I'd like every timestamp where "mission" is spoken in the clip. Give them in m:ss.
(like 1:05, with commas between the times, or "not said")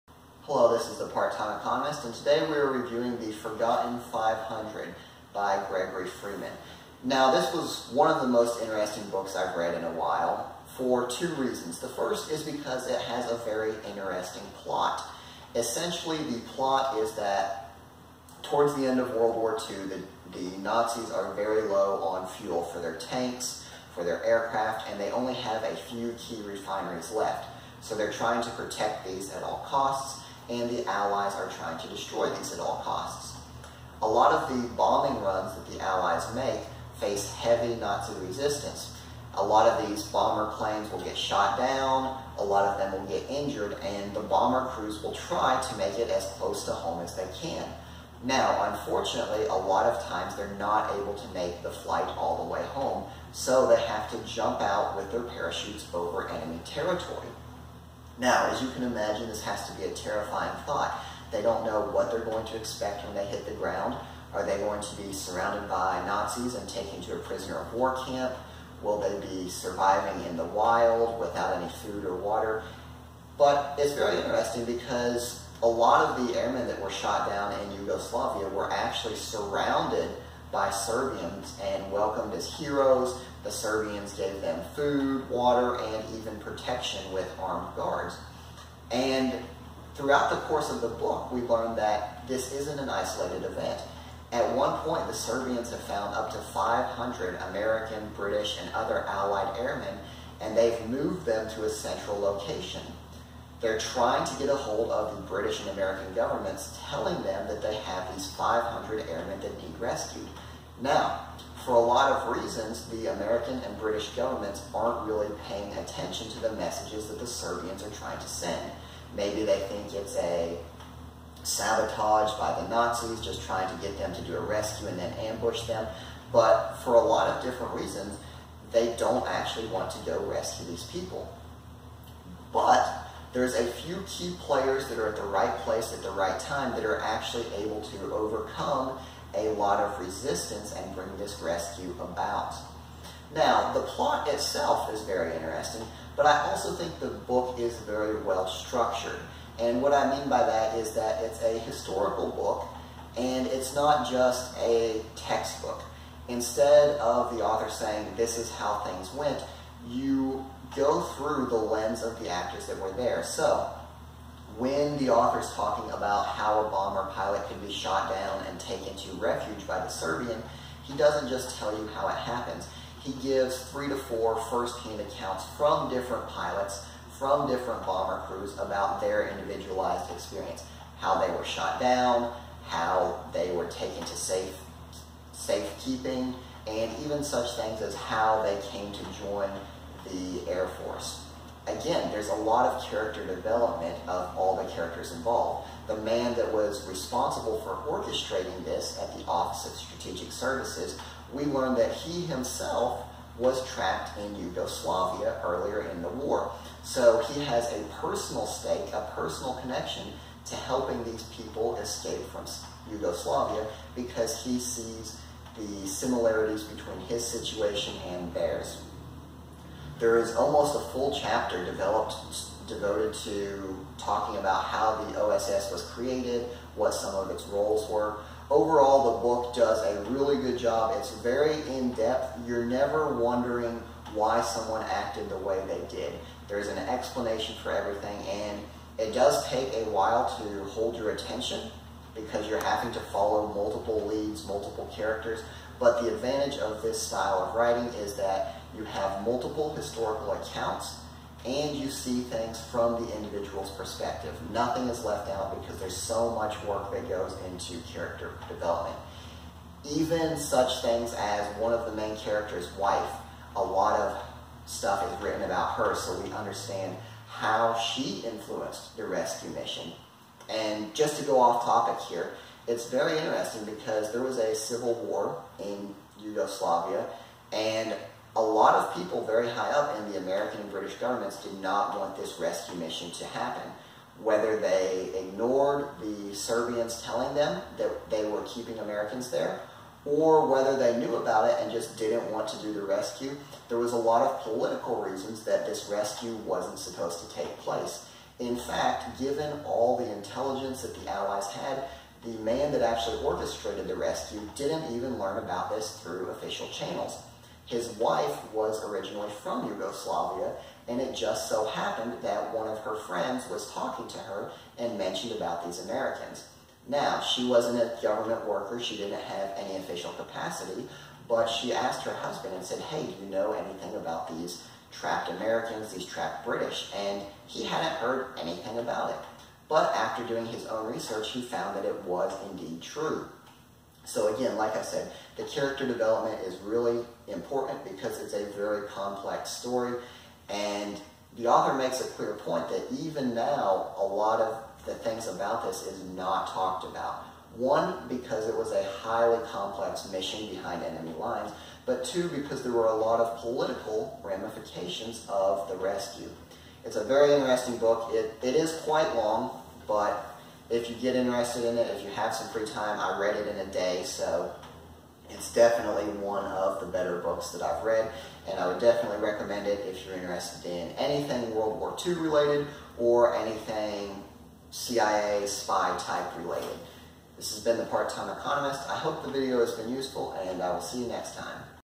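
4:29, 4:42, 5:50.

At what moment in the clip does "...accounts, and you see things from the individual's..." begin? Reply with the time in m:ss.
4:10.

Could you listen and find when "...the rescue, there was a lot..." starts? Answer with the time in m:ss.
4:52.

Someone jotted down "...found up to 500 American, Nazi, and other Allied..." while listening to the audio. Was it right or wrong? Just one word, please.
wrong.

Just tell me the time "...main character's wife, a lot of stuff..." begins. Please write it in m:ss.
4:21.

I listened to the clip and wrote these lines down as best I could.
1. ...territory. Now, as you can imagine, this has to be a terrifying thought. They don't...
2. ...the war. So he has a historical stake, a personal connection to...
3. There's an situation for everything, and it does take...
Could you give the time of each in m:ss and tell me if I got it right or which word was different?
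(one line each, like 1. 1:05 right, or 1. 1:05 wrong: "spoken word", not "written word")
1. 0:56 right
2. 3:26 wrong: "personal", not "historical"
3. 3:56 wrong: "explanation", not "situation".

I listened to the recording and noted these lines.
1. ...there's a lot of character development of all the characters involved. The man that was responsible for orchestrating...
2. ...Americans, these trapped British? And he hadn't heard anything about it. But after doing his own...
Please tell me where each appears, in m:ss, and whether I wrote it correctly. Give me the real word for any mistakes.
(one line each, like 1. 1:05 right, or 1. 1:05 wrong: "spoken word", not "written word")
1. 3:12 right
2. 5:25 right.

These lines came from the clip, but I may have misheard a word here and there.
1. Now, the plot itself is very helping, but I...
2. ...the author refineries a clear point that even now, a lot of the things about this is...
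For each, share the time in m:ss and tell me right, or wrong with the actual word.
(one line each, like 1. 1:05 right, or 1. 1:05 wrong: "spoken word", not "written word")
1. 2:23 wrong: "interesting", not "helping"
2. 5:41 wrong: "makes", not "refineries".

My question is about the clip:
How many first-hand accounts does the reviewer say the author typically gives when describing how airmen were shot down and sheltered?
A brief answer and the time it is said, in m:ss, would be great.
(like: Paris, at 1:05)
3 to 4, at 2:53.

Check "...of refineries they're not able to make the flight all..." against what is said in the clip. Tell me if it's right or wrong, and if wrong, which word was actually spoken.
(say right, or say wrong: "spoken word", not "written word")
wrong: "times", not "refineries".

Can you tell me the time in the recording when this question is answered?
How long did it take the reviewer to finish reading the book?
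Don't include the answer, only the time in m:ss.
6:03.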